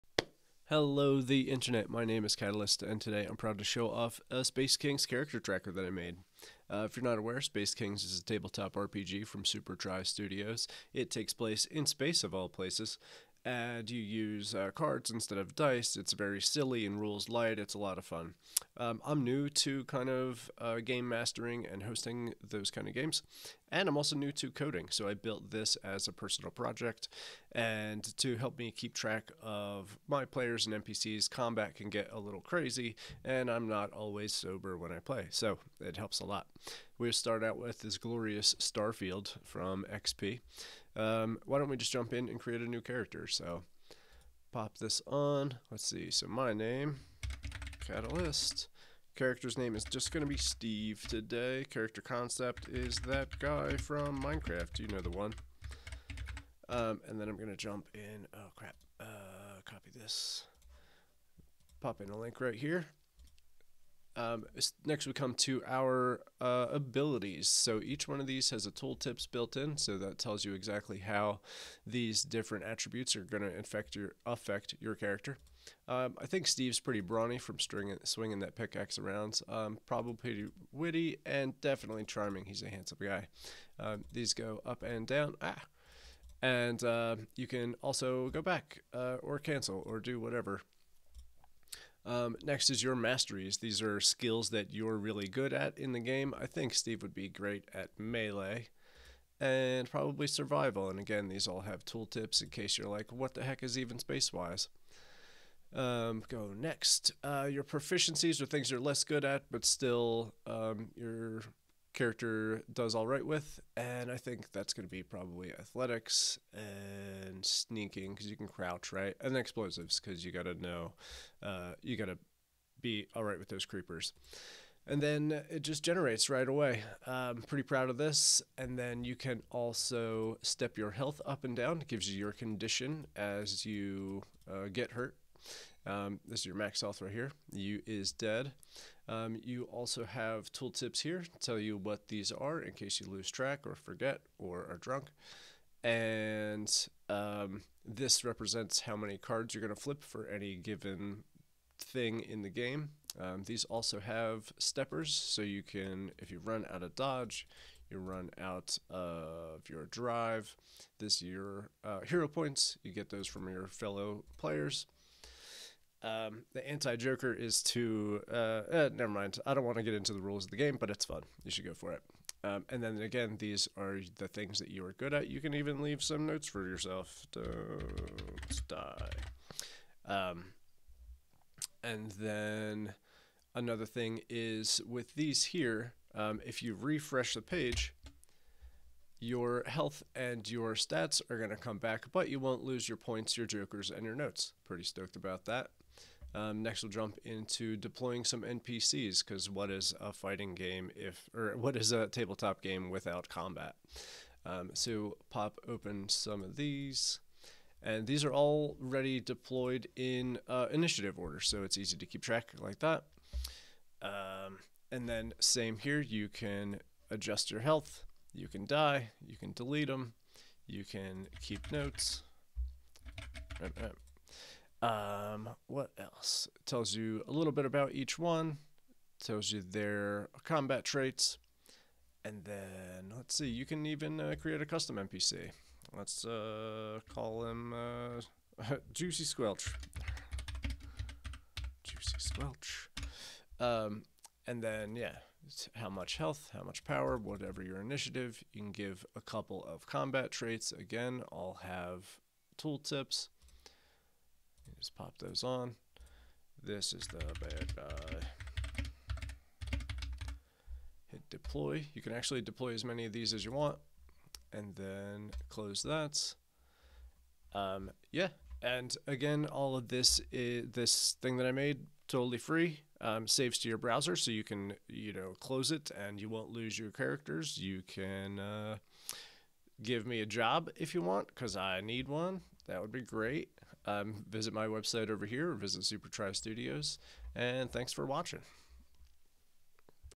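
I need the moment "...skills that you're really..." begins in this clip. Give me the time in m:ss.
1:33.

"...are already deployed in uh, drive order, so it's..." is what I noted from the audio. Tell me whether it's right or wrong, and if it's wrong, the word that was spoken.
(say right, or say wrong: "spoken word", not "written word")
wrong: "initiative", not "drive".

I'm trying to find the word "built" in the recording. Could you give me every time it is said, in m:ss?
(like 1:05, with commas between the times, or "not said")
0:25, 1:09.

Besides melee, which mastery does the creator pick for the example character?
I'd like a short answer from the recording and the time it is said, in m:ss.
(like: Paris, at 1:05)
survival, at 1:40.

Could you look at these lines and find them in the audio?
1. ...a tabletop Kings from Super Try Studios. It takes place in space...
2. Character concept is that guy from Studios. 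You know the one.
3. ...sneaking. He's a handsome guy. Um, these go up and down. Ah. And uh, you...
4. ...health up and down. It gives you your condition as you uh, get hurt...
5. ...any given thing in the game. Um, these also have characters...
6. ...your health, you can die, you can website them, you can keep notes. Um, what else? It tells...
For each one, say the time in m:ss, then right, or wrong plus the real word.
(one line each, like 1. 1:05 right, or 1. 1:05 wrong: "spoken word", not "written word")
1. 0:08 wrong: "RPG", not "Kings"
2. 0:51 wrong: "Minecraft", not "Studios"
3. 1:22 wrong: "charming", not "sneaking"
4. 2:10 right
5. 2:30 wrong: "steppers", not "characters"
6. 3:37 wrong: "delete", not "website".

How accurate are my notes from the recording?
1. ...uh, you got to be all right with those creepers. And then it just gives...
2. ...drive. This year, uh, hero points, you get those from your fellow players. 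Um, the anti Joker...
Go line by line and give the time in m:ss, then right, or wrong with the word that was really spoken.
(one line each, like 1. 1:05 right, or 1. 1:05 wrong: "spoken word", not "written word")
1. 2:01 wrong: "generates", not "gives"
2. 2:39 right.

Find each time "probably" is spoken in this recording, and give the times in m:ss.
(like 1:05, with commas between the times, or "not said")
1:19, 1:39, 1:55.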